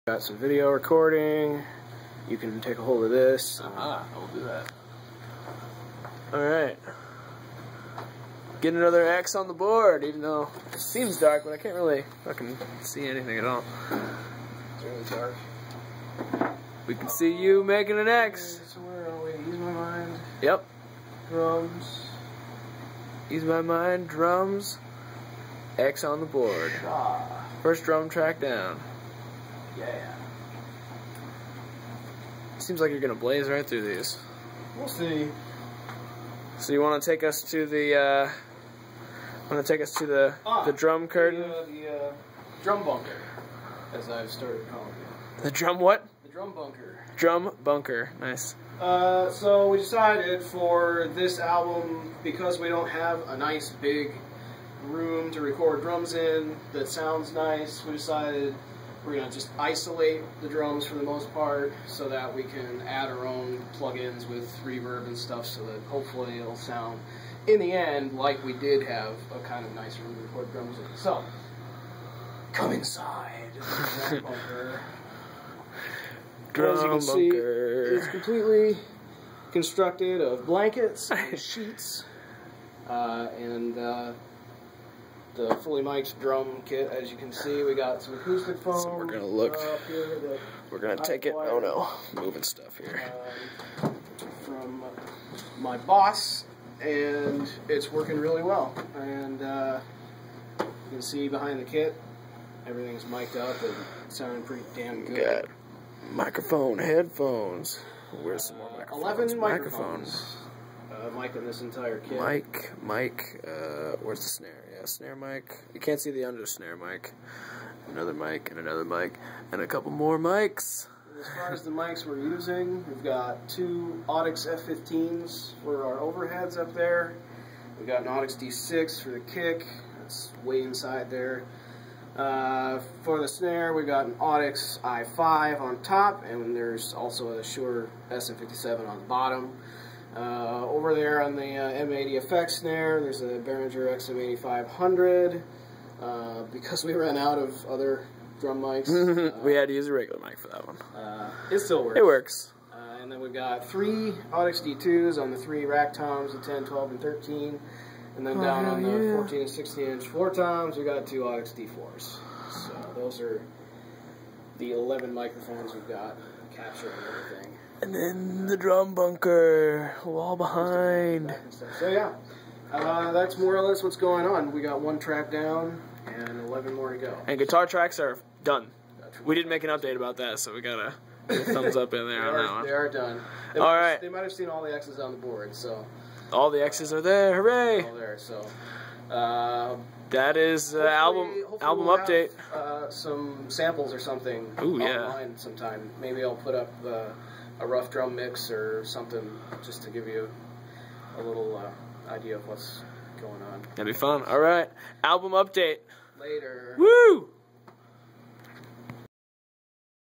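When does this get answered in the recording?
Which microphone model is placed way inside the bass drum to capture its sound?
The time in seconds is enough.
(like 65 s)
128 s.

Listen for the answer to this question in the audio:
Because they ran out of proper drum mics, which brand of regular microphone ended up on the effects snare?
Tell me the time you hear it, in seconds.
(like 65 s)
143 s.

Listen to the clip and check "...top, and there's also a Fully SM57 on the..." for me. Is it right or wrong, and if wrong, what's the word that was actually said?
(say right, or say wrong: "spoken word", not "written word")
wrong: "Shure", not "Fully".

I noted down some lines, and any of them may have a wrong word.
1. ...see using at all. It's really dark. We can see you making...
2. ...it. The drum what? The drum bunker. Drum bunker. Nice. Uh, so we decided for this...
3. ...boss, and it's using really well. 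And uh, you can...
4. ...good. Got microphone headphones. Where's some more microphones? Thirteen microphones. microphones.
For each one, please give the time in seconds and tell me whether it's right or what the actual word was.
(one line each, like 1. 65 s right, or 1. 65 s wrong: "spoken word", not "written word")
1. 12 s wrong: "anything", not "using"
2. 45 s right
3. 95 s wrong: "working", not "using"
4. 105 s wrong: "Eleven", not "Thirteen".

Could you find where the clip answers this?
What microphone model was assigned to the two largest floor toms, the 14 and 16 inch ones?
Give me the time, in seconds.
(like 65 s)
161 s.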